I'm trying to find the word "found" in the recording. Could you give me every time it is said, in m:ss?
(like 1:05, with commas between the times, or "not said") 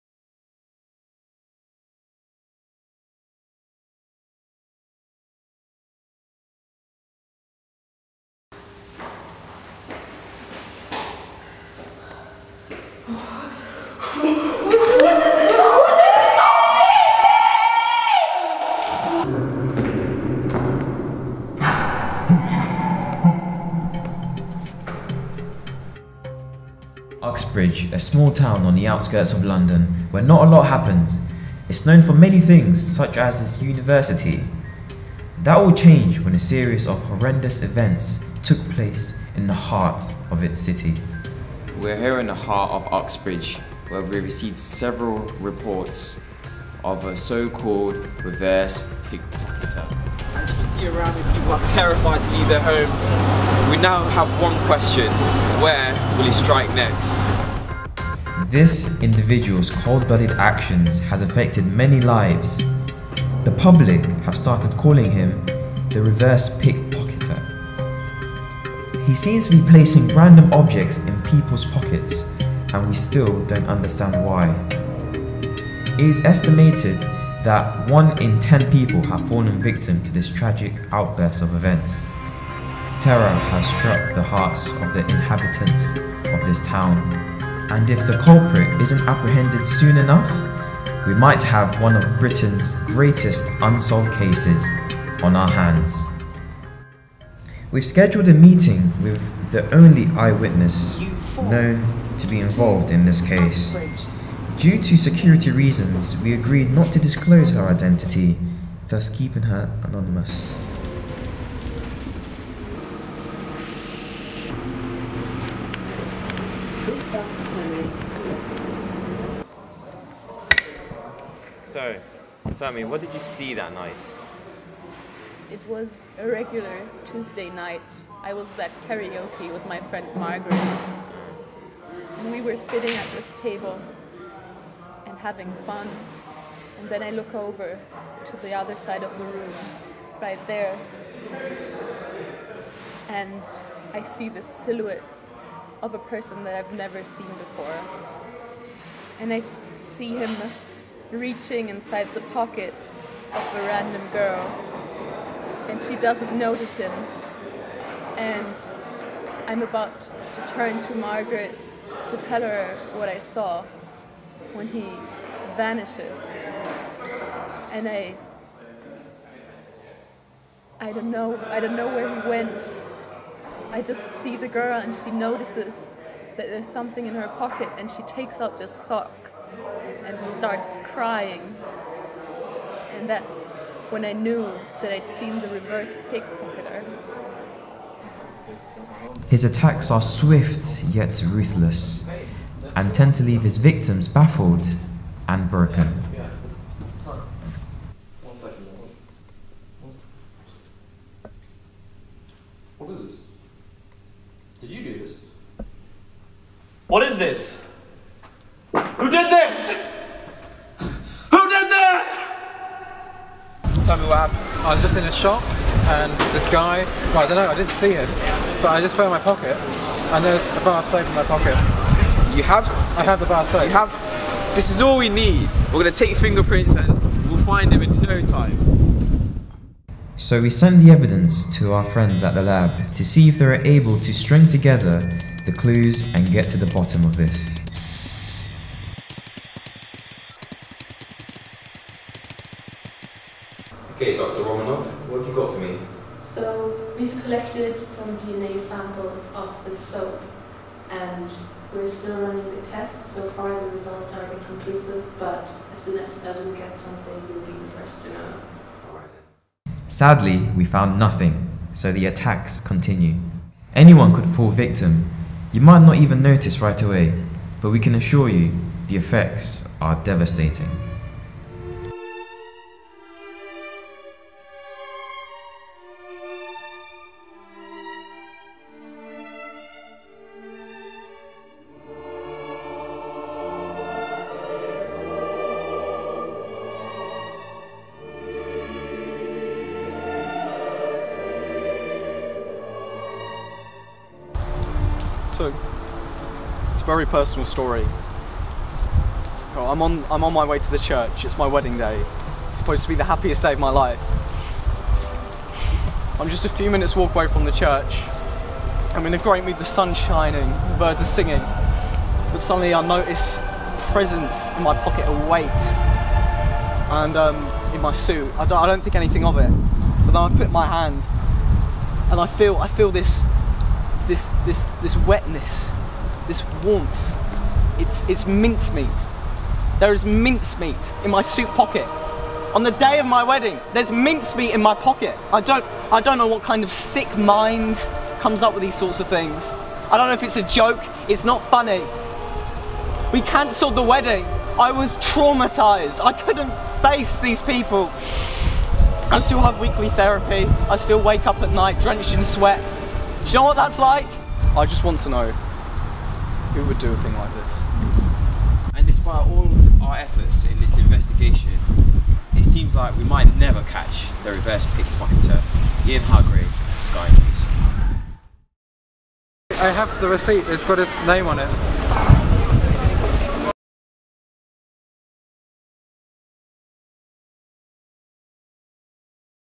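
3:38, 4:20.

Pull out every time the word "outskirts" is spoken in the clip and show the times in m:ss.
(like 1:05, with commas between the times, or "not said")
0:28.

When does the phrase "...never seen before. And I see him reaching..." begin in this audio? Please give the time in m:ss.
2:26.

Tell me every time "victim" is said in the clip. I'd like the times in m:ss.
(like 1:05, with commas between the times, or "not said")
1:19, 3:13, 4:24.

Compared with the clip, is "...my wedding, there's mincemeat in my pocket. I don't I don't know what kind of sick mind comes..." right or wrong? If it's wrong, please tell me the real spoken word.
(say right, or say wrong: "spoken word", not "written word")
right.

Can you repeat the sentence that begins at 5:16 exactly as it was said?
And um, in my suit, I don't, I don't think anything of it.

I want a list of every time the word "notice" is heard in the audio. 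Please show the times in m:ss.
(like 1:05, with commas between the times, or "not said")
2:36, 2:55, 4:26, 5:12.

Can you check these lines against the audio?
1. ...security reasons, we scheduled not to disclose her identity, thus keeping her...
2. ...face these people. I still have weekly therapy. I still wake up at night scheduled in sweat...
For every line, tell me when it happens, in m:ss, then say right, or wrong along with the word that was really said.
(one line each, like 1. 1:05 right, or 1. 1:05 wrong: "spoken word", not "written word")
1. 1:44 wrong: "agreed", not "scheduled"
2. 5:46 wrong: "drenched", not "scheduled".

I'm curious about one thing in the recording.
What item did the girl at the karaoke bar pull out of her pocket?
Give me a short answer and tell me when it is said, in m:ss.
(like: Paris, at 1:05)
sock, at 2:58.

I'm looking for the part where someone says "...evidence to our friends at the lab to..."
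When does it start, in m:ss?
3:50.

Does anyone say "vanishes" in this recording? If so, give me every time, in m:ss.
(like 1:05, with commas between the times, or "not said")
2:45.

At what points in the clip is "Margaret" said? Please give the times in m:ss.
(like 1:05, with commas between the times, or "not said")
2:10, 2:40.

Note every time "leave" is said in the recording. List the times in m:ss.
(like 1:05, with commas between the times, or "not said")
0:52, 3:13.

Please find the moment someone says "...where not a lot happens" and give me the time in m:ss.
0:30.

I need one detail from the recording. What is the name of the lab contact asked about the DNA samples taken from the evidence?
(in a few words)
Dr. Romanov.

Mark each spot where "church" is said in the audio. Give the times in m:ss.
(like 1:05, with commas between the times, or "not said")
5:00, 5:07.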